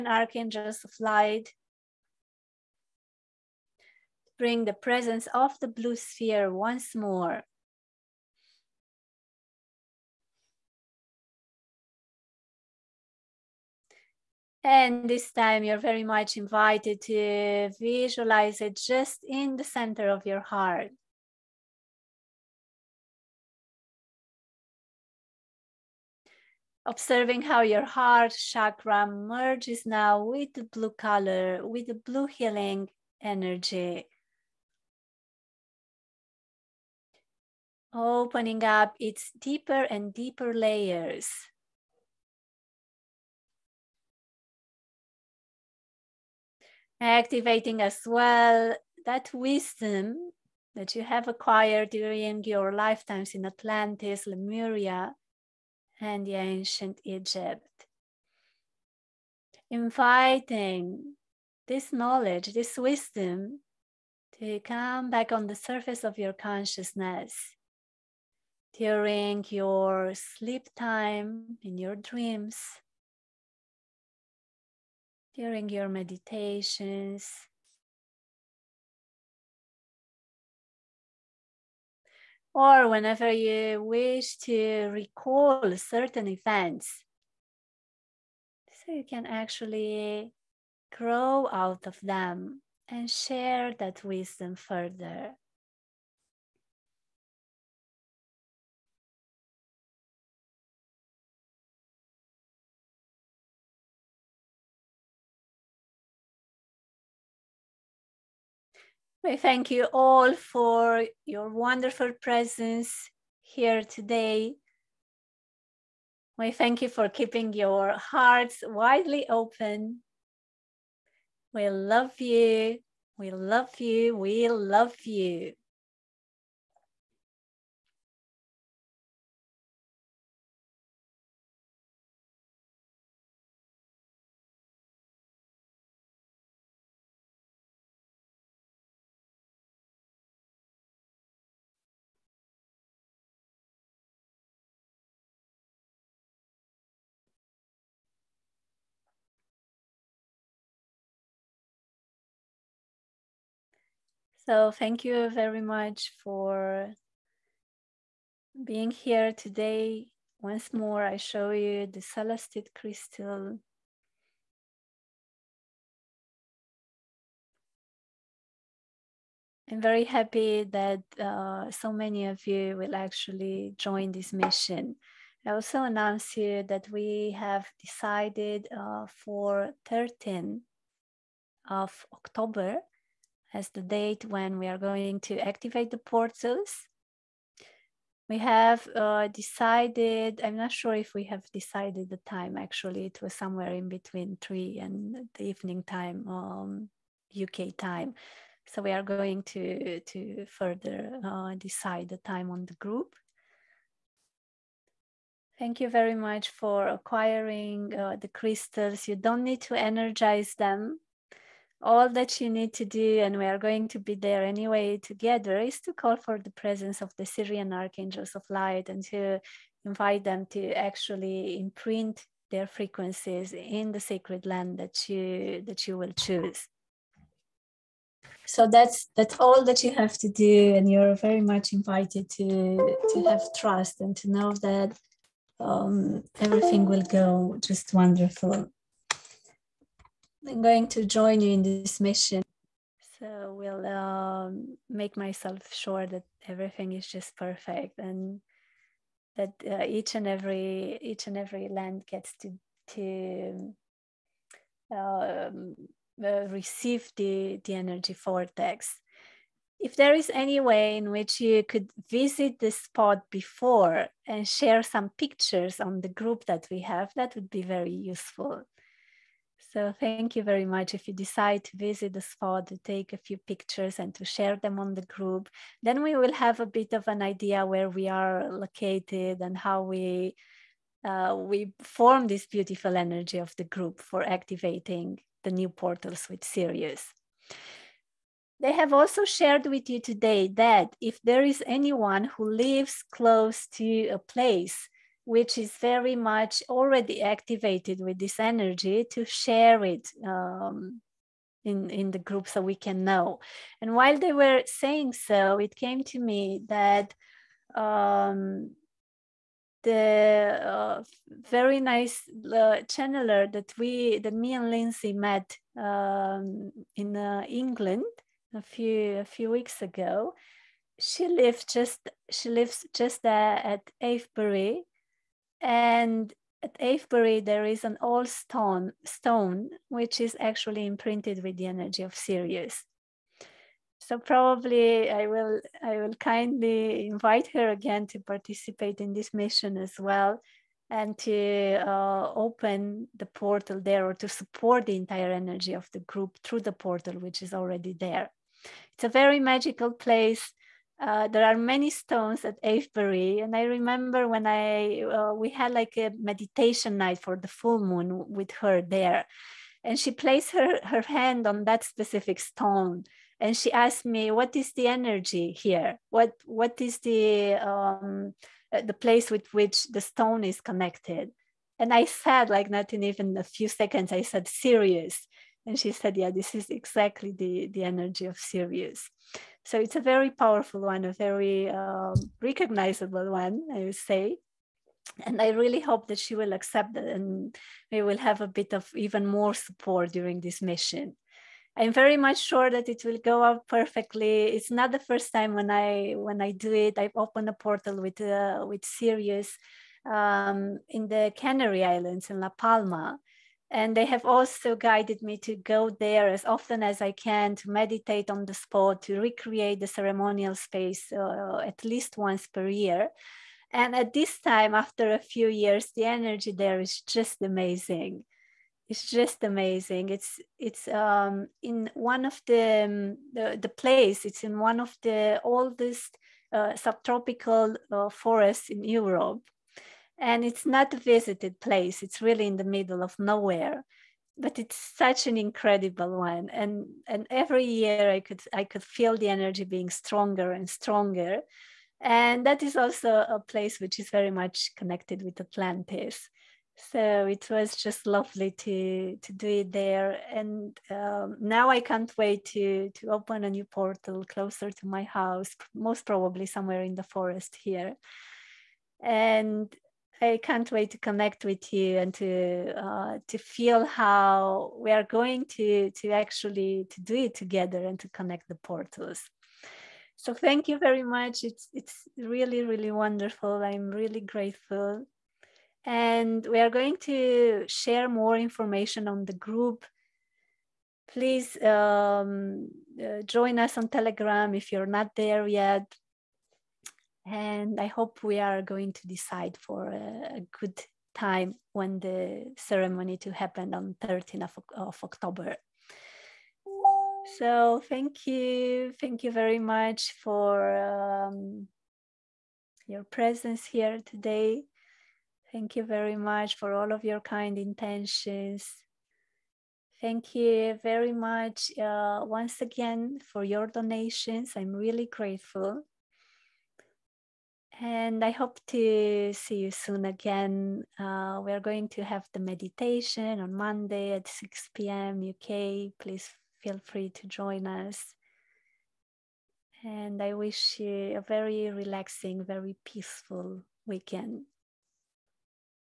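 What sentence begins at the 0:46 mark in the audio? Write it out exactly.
activating as well that wisdom that you have acquired during your lifetimes in Atlantis, Lemuria, and the ancient Egypt.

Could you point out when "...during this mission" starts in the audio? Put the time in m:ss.
6:30.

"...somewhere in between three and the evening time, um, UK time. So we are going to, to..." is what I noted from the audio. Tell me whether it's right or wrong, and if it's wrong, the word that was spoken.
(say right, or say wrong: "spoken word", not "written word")
right.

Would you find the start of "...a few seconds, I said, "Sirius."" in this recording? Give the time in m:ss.
6:13.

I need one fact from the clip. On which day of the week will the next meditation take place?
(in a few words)
Monday.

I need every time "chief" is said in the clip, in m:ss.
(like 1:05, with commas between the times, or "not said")
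not said.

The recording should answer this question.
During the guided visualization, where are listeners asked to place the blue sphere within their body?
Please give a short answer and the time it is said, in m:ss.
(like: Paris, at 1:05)
Center of your heart, at 0:19.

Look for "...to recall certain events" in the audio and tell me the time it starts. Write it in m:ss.
1:24.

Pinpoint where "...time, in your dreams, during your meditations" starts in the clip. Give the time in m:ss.
1:10.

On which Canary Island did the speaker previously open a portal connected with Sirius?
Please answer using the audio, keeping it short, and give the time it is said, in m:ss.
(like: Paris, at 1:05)
La Palma, at 6:42.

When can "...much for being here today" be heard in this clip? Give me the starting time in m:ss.
2:35.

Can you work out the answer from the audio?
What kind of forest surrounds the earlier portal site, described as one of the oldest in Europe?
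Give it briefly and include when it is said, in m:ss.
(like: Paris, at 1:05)
Subtropical, at 7:06.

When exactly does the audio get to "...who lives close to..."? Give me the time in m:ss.
4:52.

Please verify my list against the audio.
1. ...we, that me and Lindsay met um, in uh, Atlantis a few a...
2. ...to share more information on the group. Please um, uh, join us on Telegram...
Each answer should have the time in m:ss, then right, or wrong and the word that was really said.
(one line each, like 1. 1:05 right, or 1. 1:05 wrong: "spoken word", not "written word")
1. 5:13 wrong: "England", not "Atlantis"
2. 7:57 right.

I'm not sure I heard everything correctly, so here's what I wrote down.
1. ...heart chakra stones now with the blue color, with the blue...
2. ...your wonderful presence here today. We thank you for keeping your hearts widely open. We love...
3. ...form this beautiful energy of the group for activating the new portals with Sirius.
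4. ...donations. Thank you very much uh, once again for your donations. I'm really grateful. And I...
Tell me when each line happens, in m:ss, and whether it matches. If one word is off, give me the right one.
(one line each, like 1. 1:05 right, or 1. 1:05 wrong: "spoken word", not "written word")
1. 0:27 wrong: "merges", not "stones"
2. 1:51 right
3. 4:41 right
4. 8:27 wrong: "intentions", not "donations".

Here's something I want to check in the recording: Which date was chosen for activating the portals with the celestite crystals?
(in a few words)
13 October.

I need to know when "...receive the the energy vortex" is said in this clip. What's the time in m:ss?
4:16.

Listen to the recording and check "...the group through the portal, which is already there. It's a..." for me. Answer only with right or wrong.
right.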